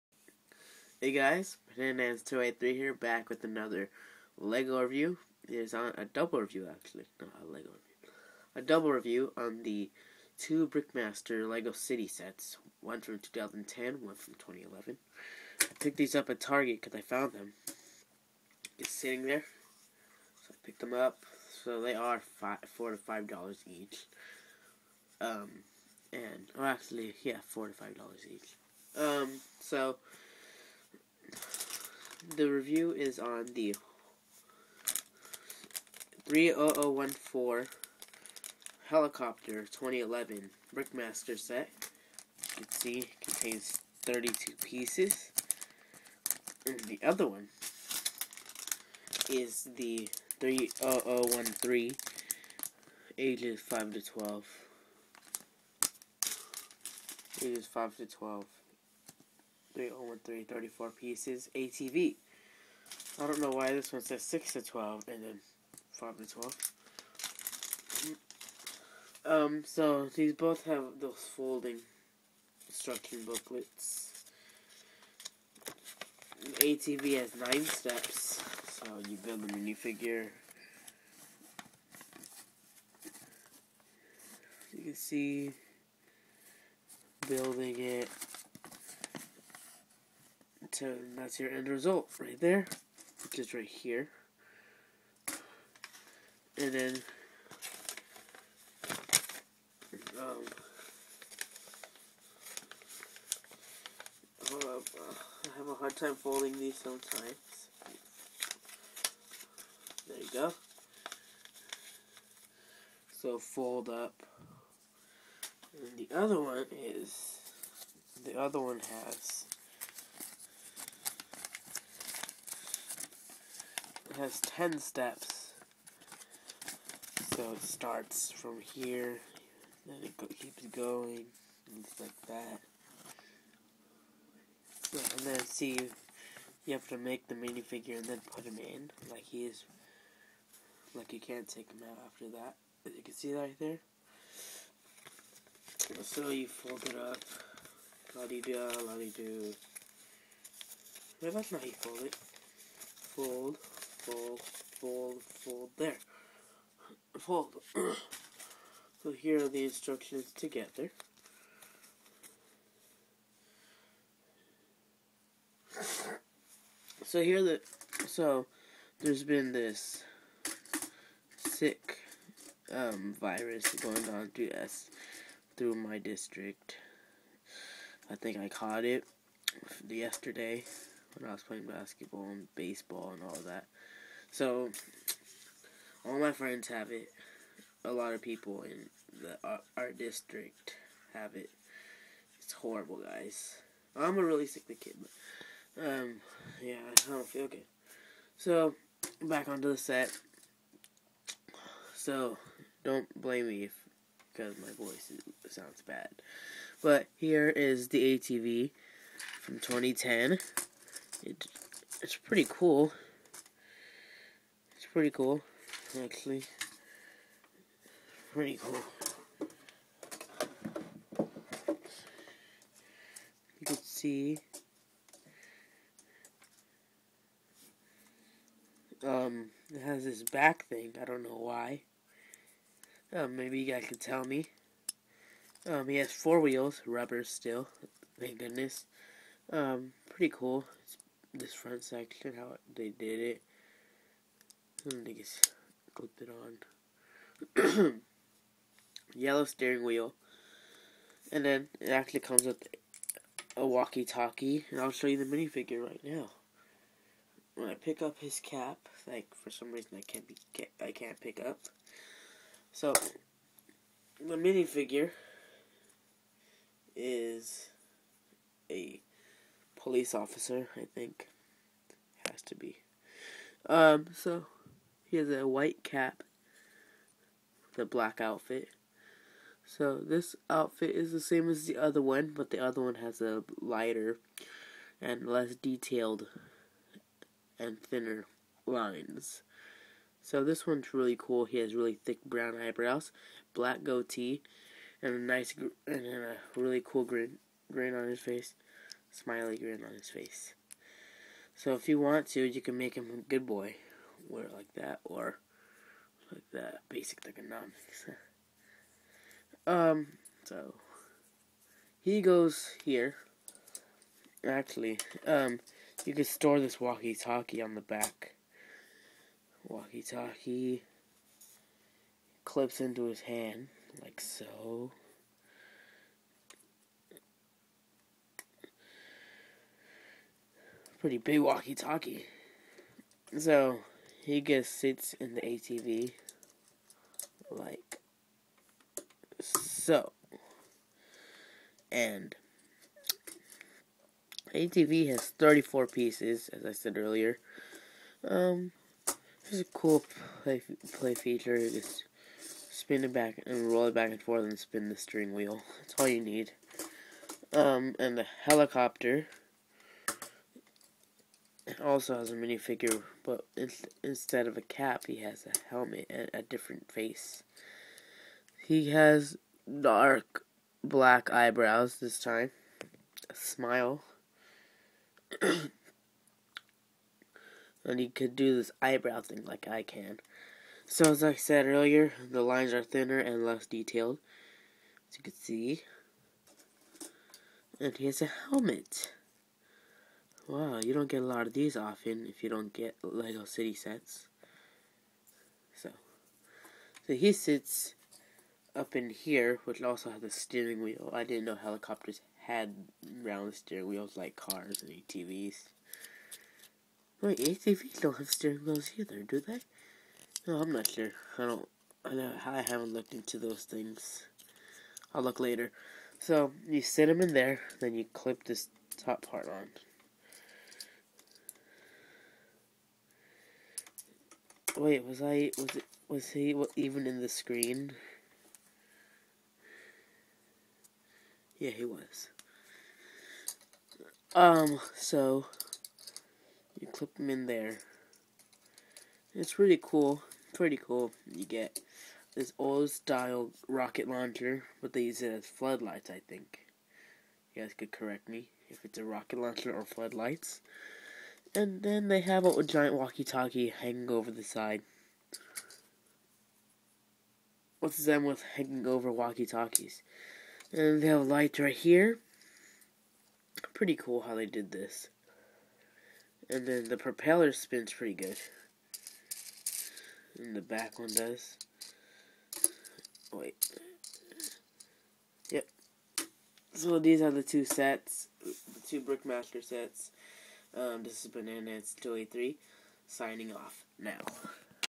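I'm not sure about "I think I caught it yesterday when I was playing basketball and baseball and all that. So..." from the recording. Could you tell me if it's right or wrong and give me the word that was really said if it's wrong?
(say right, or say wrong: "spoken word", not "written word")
right.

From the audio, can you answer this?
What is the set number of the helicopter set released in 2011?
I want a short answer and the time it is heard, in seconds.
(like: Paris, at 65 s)
30014, at 36 s.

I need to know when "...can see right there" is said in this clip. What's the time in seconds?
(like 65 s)
143 s.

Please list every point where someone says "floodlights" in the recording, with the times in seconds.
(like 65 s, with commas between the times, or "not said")
445 s, 449 s.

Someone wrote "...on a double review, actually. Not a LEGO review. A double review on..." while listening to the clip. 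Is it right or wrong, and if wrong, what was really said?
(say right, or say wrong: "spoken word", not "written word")
right.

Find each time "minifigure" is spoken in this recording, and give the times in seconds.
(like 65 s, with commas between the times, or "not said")
79 s, 137 s, 255 s, 264 s, 362 s.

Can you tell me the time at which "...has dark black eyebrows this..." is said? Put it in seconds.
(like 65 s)
368 s.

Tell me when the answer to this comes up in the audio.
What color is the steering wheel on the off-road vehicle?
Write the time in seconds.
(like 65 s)
249 s.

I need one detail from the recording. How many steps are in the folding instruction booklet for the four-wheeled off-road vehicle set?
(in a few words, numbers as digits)
9.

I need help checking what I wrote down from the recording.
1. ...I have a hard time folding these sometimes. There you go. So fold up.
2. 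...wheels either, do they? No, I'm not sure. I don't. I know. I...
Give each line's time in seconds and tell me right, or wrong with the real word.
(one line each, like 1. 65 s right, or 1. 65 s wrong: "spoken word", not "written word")
1. 104 s right
2. 408 s right.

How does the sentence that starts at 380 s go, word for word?
So, as I said earlier, the lines are thinner and less detailed, as you can see.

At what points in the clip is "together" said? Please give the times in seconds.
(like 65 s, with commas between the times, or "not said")
160 s.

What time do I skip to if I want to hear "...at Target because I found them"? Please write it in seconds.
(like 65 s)
16 s.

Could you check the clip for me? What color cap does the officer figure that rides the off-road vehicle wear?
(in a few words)
White.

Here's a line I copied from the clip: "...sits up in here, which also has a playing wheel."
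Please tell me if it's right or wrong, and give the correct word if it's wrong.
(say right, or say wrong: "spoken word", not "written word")
wrong: "steering", not "playing".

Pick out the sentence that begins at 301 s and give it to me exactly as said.
So if you want to, you can make him a good boy wear it like that or like the basic economics.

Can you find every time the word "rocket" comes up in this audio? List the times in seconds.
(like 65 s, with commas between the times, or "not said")
443 s, 449 s.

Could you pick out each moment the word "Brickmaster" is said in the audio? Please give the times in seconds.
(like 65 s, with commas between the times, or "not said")
10 s, 40 s, 479 s.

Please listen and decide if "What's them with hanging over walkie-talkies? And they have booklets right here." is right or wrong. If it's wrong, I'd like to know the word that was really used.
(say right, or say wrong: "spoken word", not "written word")
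wrong: "lights", not "booklets".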